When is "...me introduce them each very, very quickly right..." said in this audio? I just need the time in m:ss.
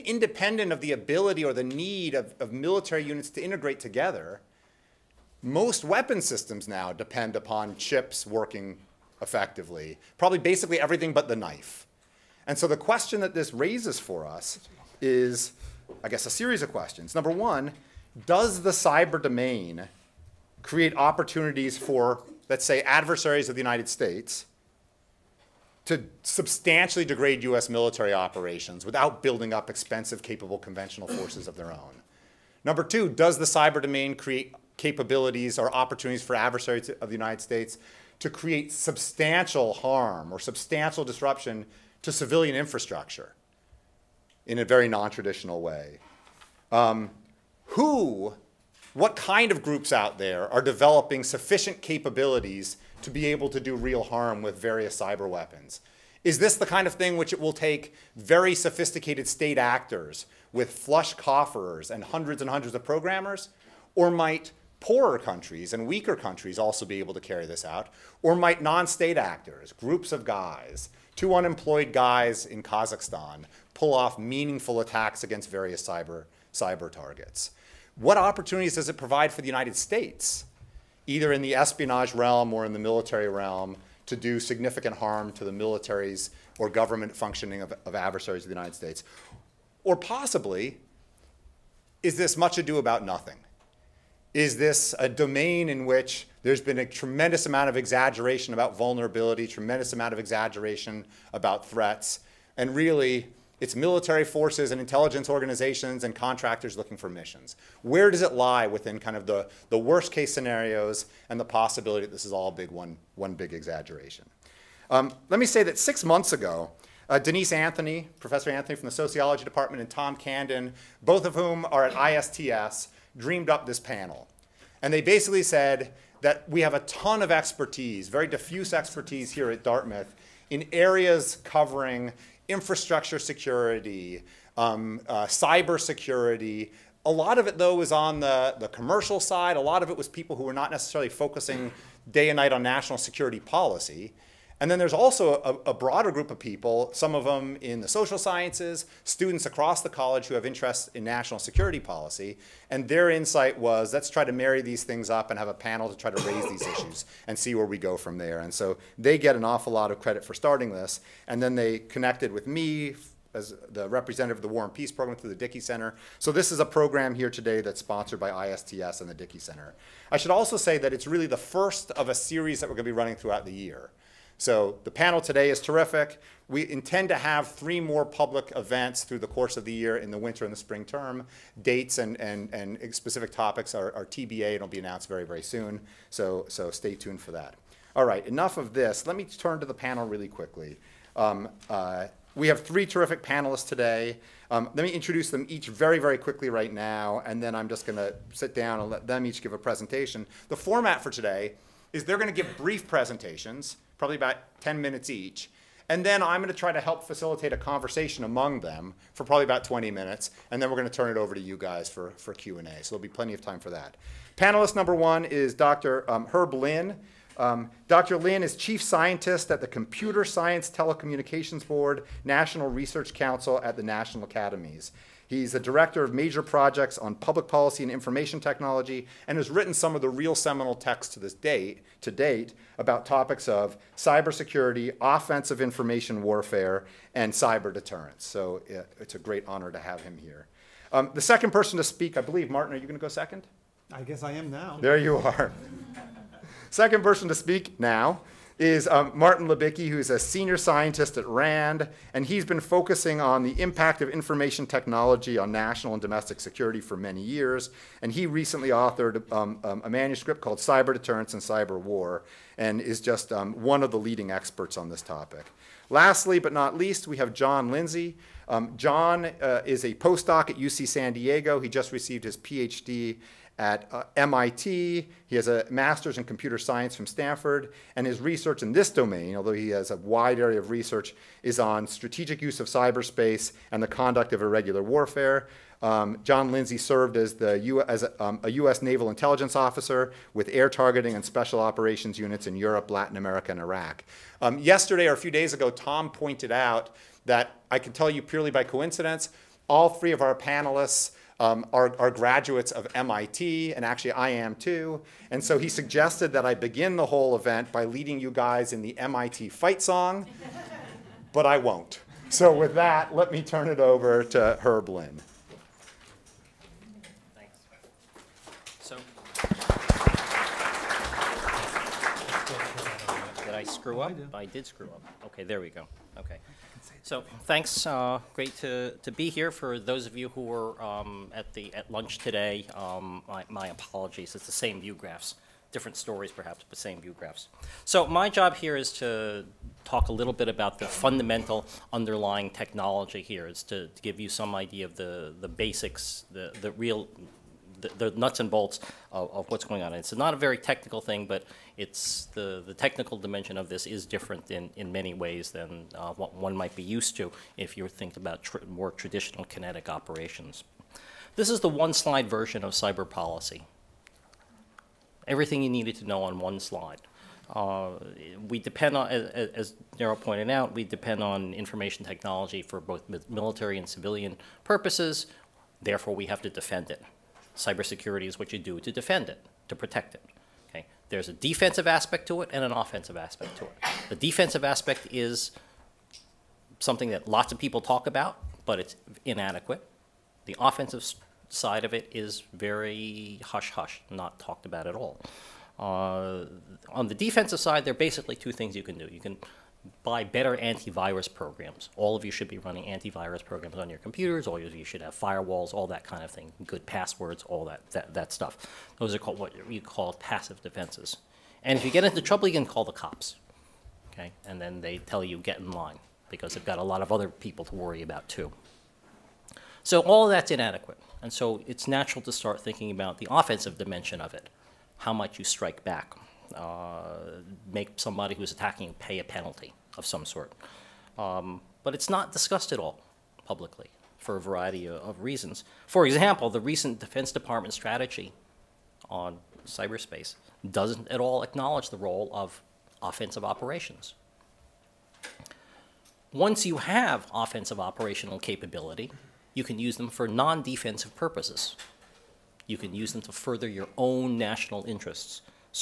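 3:14.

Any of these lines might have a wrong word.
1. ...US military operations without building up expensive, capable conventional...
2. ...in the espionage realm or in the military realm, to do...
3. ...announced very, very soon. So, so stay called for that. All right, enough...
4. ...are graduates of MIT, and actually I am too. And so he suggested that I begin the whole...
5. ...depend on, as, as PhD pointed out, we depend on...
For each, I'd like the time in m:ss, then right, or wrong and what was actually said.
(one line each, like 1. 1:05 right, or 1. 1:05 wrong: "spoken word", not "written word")
1. 0:27 right
2. 1:21 right
3. 3:04 wrong: "tuned", not "called"
4. 5:01 right
5. 6:08 wrong: "Daryl", not "PhD".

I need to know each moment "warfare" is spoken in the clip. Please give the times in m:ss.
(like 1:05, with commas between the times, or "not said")
3:56, 4:44.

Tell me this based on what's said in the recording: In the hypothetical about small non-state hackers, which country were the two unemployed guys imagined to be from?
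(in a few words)
Kazakhstan.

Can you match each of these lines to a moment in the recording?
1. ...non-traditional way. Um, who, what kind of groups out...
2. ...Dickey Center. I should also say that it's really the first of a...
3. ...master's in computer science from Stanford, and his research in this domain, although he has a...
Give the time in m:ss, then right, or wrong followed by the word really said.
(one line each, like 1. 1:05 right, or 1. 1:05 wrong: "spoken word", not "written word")
1. 0:44 right
2. 2:49 right
3. 4:35 right.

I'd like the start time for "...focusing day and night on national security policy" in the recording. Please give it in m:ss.
2:21.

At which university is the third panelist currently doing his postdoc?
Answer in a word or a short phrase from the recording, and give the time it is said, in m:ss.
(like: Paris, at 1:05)
UC San Diego, at 4:30.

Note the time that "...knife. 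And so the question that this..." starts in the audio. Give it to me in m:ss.
0:11.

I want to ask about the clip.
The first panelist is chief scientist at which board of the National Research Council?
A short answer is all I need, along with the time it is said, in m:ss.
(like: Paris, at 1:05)
Computer Science Telecommunications Board, at 3:39.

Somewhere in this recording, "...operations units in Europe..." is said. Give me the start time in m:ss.
4:51.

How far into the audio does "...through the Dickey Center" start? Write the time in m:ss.
2:45.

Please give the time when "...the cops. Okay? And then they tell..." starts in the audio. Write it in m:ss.
6:52.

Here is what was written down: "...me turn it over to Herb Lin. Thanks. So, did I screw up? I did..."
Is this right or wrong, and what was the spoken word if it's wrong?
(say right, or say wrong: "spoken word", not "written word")
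right.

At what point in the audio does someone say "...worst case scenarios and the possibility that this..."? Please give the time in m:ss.
1:49.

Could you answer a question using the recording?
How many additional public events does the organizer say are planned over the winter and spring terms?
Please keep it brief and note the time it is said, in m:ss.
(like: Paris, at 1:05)
3, at 2:57.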